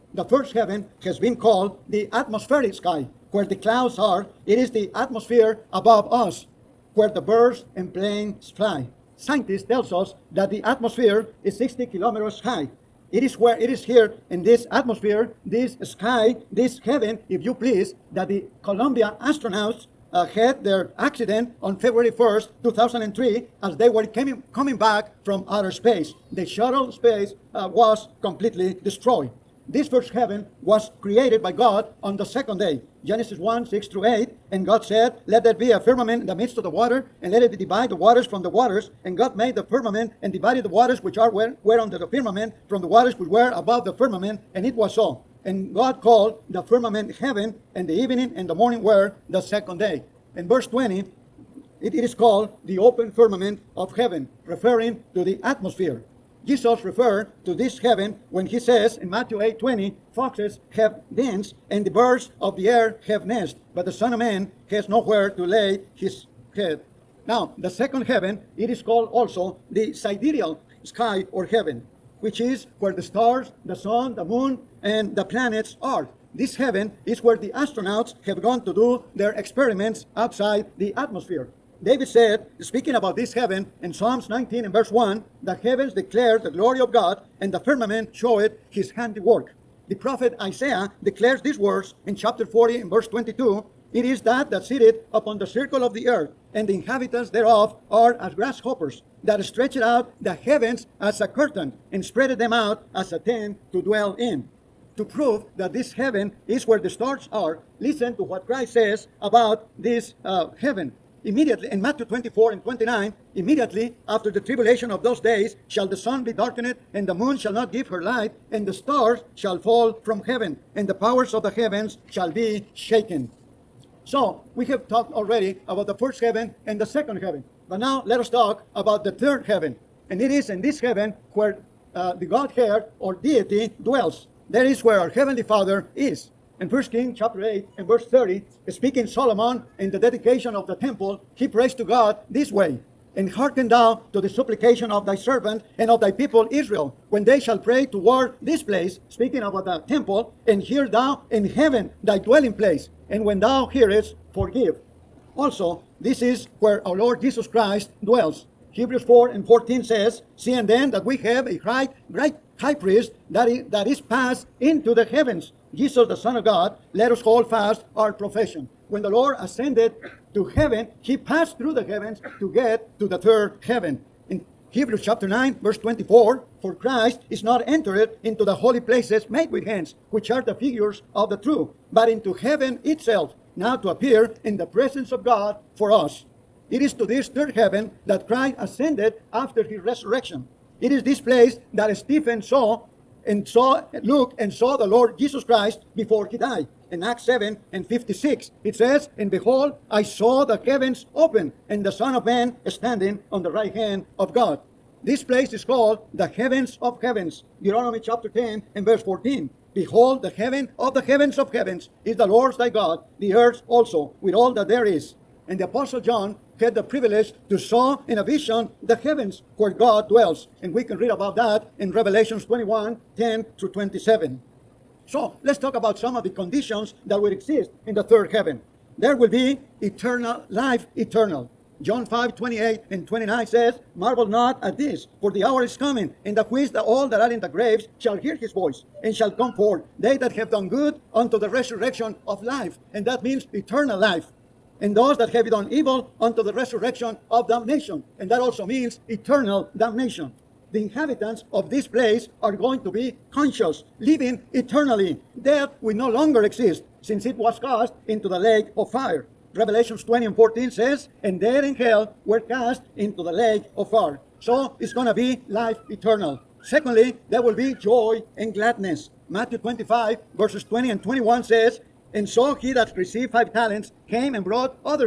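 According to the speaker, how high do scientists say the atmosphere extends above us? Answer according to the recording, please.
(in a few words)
60 kilometers.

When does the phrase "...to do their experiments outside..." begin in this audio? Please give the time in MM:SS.
01:18.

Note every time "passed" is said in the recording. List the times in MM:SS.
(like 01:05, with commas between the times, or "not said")
02:43, 02:51.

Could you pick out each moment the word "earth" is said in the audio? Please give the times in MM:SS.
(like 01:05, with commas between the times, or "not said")
01:36, 03:33.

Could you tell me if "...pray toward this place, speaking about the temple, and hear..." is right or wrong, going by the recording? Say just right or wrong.
right.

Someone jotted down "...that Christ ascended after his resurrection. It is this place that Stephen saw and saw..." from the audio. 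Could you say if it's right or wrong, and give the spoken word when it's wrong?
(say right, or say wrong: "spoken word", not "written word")
right.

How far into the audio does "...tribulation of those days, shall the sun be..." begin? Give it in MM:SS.
01:54.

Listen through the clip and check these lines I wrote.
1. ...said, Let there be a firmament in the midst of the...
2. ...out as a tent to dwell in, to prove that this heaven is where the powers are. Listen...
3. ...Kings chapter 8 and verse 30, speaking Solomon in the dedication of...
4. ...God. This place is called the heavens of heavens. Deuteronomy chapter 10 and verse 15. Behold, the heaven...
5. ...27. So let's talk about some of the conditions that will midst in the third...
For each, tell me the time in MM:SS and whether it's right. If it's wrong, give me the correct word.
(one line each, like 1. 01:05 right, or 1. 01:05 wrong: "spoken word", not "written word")
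1. 00:34 right
2. 01:42 wrong: "stars", not "powers"
3. 02:16 right
4. 03:24 wrong: "14", not "15"
5. 03:43 wrong: "exist", not "midst".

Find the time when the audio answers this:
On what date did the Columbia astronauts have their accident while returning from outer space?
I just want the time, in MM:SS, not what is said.
00:21.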